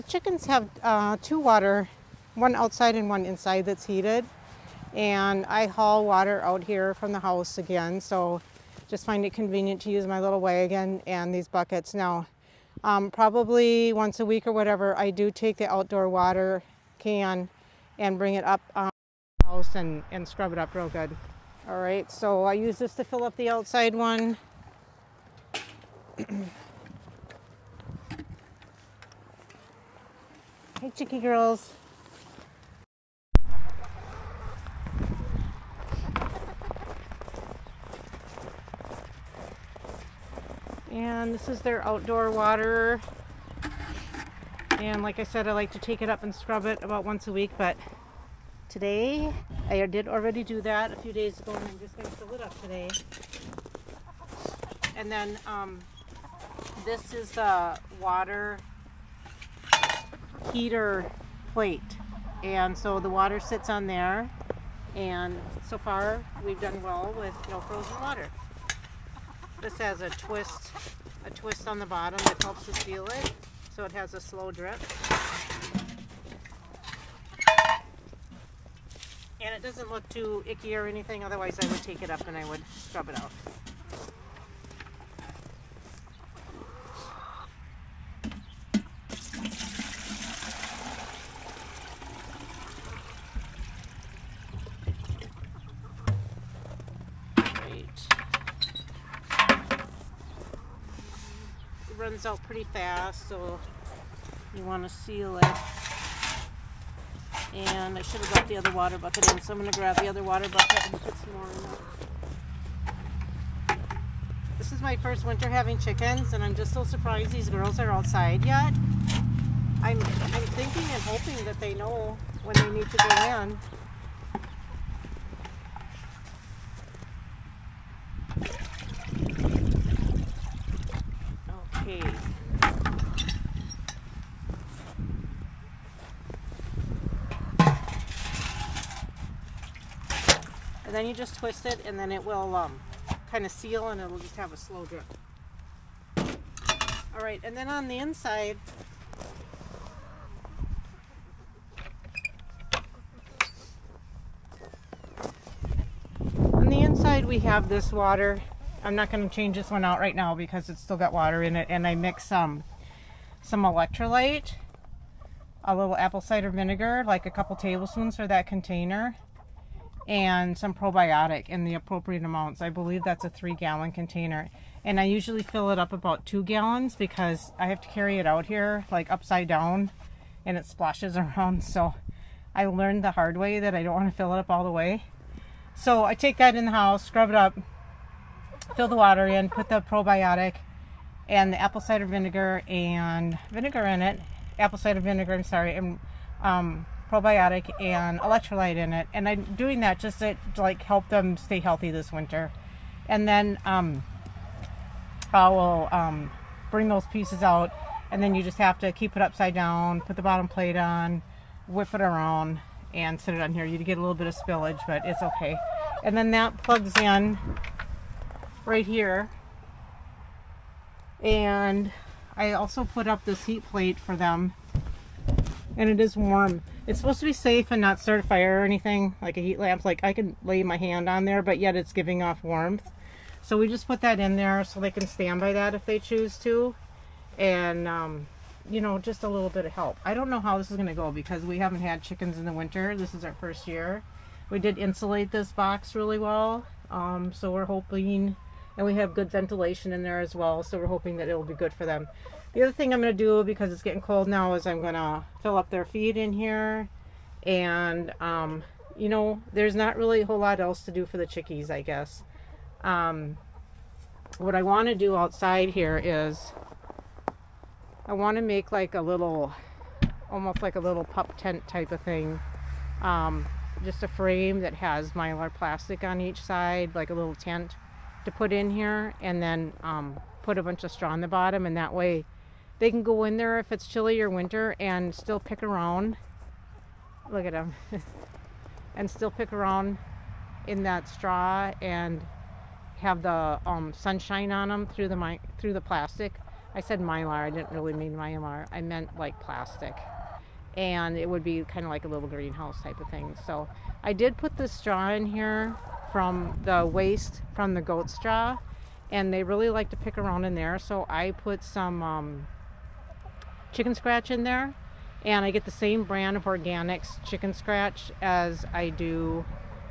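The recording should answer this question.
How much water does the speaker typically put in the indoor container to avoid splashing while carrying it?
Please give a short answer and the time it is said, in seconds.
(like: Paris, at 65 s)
2 gallons, at 176 s.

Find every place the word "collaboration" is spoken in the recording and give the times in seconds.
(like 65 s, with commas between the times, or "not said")
not said.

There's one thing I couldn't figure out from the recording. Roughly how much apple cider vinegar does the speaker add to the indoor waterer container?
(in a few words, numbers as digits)
a couple tablespoons.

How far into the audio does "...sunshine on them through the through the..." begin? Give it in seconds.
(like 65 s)
293 s.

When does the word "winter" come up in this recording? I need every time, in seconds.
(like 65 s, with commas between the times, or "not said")
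115 s, 202 s, 242 s, 284 s.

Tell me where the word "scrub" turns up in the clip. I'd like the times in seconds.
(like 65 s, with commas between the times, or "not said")
20 s, 46 s, 82 s, 187 s.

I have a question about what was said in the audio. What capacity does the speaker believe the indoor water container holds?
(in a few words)
3 gallons.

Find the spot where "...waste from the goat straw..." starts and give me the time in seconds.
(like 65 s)
306 s.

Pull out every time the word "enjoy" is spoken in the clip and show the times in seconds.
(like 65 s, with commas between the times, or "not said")
not said.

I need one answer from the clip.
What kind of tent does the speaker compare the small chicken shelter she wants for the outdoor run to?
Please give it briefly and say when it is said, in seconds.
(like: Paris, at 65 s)
pup tent, at 271 s.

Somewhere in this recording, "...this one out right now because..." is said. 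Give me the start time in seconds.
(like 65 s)
159 s.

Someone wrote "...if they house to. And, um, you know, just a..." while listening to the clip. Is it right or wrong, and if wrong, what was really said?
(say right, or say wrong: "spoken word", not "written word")
wrong: "choose", not "house".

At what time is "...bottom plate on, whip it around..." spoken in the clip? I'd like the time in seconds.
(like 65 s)
210 s.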